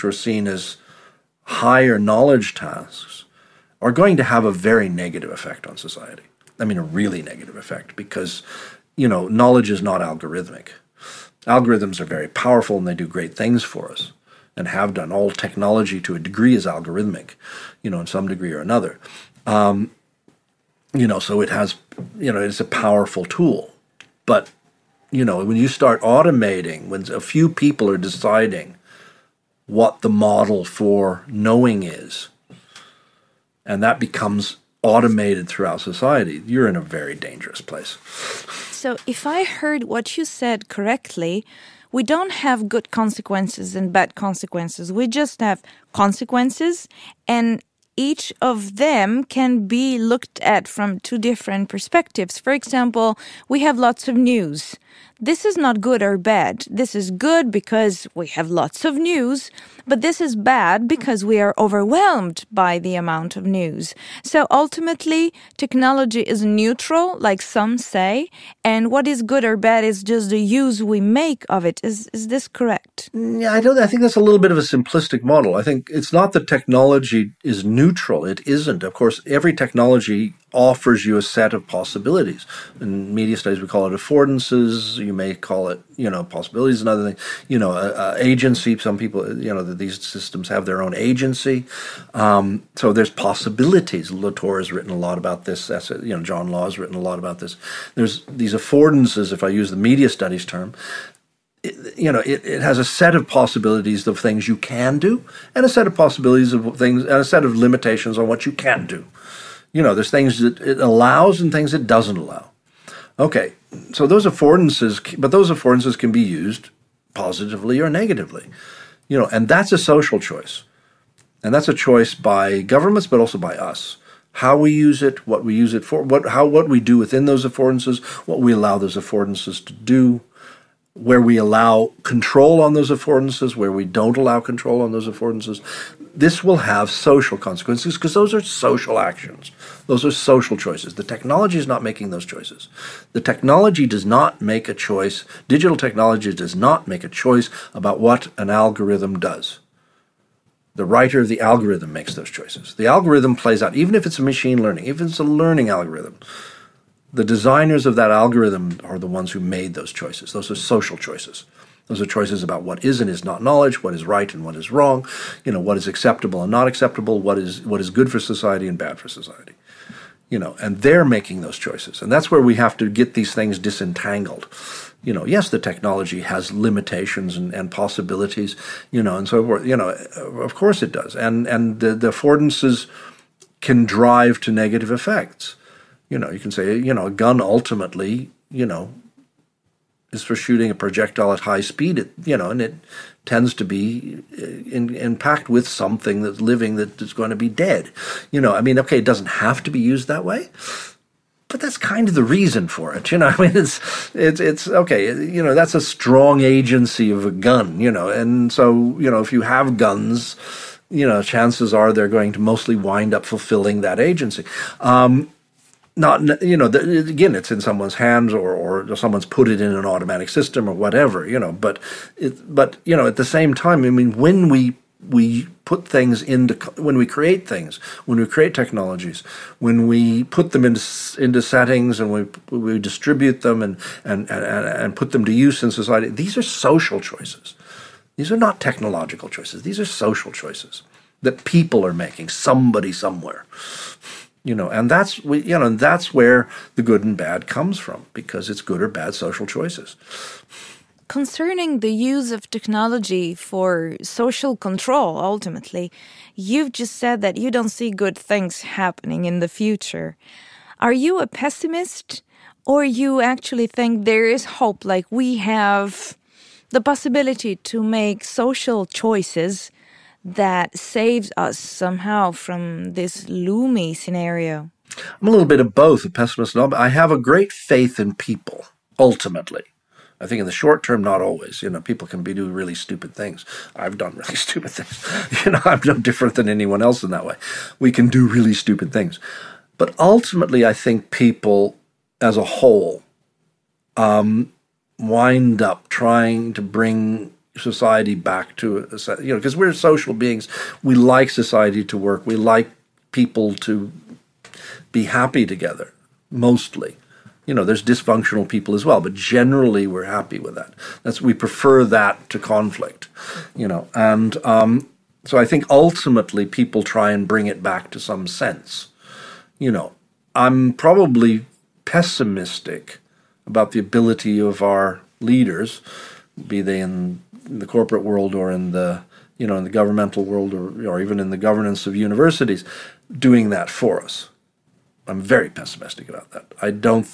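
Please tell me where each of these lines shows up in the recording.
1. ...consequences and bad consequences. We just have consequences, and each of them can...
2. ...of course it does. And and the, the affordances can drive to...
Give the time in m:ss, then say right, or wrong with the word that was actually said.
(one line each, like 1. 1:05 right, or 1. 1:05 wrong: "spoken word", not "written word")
1. 0:42 right
2. 2:59 right.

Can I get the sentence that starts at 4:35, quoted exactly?
I'm a little bit of both, a pessimist and all, but I have a great faith in people, ultimately.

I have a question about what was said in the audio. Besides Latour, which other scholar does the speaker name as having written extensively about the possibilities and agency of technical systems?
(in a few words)
John Law.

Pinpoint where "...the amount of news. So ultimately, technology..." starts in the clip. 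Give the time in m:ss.
1:02.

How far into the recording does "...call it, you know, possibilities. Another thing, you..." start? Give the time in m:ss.
1:25.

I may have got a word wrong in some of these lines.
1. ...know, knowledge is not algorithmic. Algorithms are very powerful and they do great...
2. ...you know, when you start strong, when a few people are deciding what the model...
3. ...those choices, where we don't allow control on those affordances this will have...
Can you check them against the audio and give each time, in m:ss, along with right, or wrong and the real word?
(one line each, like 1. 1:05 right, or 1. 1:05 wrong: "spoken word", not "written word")
1. 0:09 right
2. 0:25 wrong: "automating", not "strong"
3. 2:12 wrong: "affordances", not "choices".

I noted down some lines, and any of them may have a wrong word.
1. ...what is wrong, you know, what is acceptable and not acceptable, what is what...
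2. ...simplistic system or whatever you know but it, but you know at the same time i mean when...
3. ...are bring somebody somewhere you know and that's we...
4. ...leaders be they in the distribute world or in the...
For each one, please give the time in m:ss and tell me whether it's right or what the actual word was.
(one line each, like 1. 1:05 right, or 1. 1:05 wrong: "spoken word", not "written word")
1. 2:44 right
2. 3:39 wrong: "automatic", not "simplistic"
3. 4:01 wrong: "making", not "bring"
4. 5:25 wrong: "corporate", not "distribute".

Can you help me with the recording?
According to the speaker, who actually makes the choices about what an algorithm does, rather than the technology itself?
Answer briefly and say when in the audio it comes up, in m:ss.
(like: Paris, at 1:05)
the writer of the algorithm, at 2:30.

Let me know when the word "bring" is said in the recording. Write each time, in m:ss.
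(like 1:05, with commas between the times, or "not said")
4:56, 5:17.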